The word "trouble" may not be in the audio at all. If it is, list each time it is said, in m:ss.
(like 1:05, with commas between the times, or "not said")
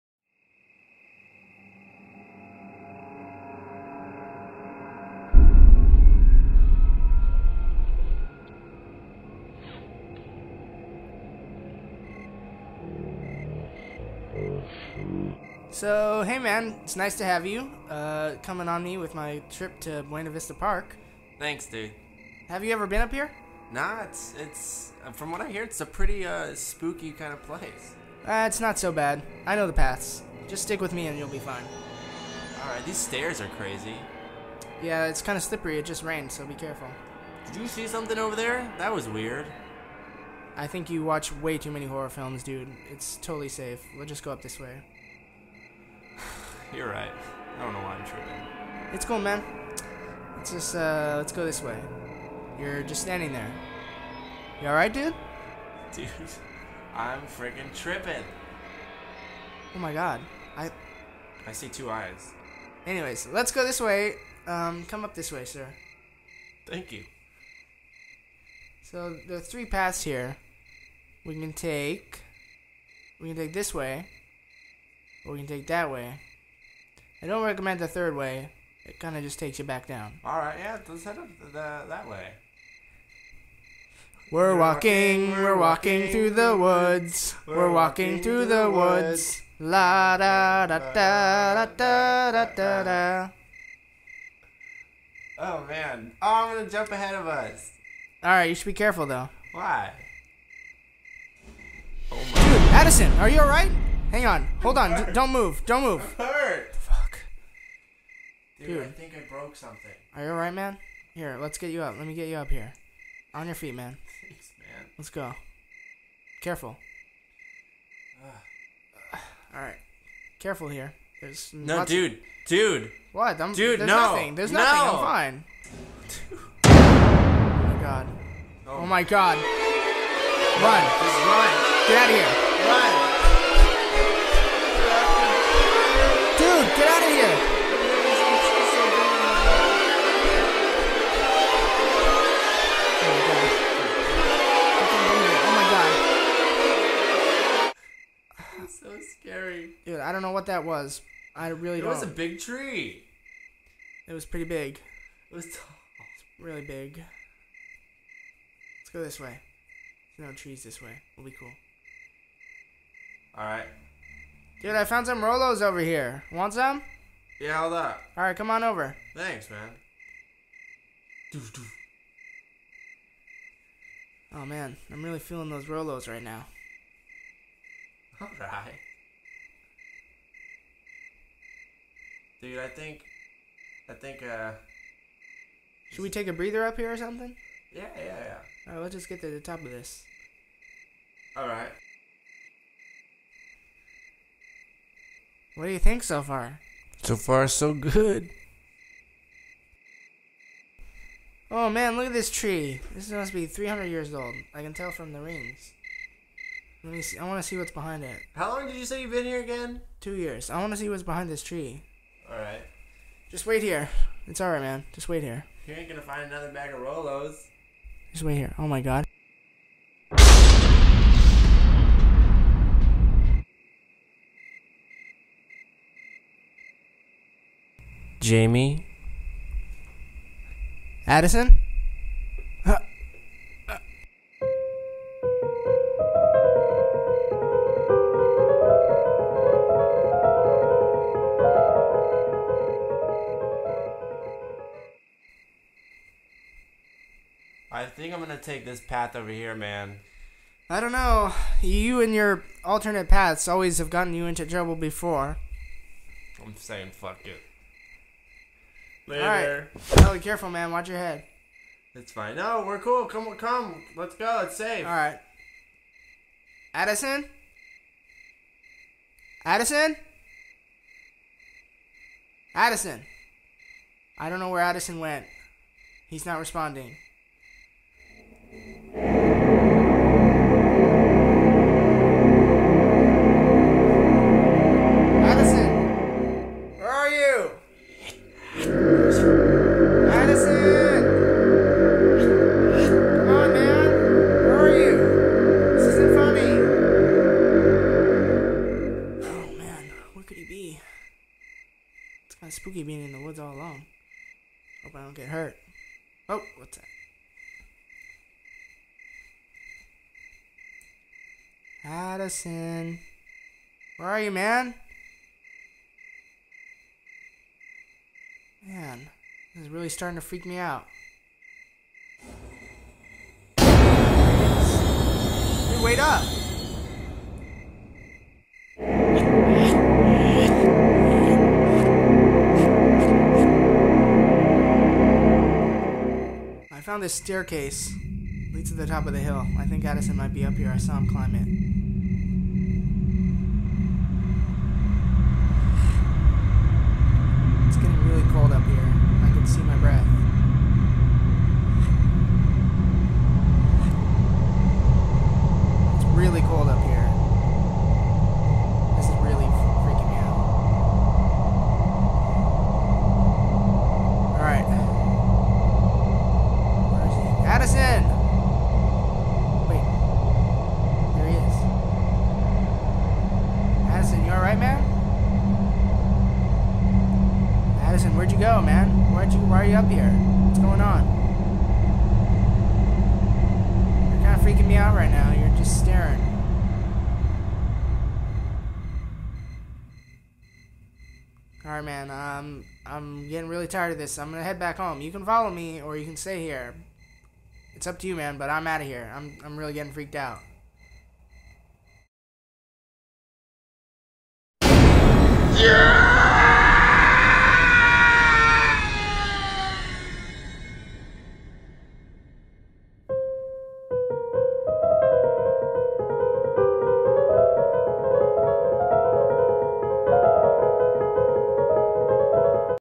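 4:14.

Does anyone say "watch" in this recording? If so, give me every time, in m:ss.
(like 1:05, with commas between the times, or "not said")
0:41, 4:20.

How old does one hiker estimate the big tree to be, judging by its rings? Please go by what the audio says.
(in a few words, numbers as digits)
300 years.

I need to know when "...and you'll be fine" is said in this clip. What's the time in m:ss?
0:31.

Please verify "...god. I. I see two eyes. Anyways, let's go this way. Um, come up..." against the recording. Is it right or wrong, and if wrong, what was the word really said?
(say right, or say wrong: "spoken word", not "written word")
right.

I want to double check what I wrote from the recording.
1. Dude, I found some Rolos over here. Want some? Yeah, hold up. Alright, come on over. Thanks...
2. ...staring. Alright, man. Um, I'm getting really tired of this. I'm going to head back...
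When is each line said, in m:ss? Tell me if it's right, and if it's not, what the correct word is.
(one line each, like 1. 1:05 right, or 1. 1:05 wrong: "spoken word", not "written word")
1. 2:44 right
2. 6:25 right.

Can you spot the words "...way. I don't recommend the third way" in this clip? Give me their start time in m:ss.
1:15.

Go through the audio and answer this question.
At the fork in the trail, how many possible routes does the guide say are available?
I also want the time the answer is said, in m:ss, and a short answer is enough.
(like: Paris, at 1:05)
3, at 1:09.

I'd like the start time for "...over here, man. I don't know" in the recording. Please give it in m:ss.
4:09.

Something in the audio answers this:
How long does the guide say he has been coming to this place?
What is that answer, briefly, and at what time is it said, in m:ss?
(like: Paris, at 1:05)
2 years, at 3:30.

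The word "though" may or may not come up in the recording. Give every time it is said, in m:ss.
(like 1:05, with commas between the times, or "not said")
1:39.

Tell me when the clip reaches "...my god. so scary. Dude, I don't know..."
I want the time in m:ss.
2:28.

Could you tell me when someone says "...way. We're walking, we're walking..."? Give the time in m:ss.
1:22.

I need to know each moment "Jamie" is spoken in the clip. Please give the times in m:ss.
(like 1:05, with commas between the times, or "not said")
3:48.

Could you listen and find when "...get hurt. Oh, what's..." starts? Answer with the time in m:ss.
5:05.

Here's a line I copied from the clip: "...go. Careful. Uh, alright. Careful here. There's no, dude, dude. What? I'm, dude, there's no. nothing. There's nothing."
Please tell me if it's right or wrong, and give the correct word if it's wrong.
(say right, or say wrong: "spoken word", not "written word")
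right.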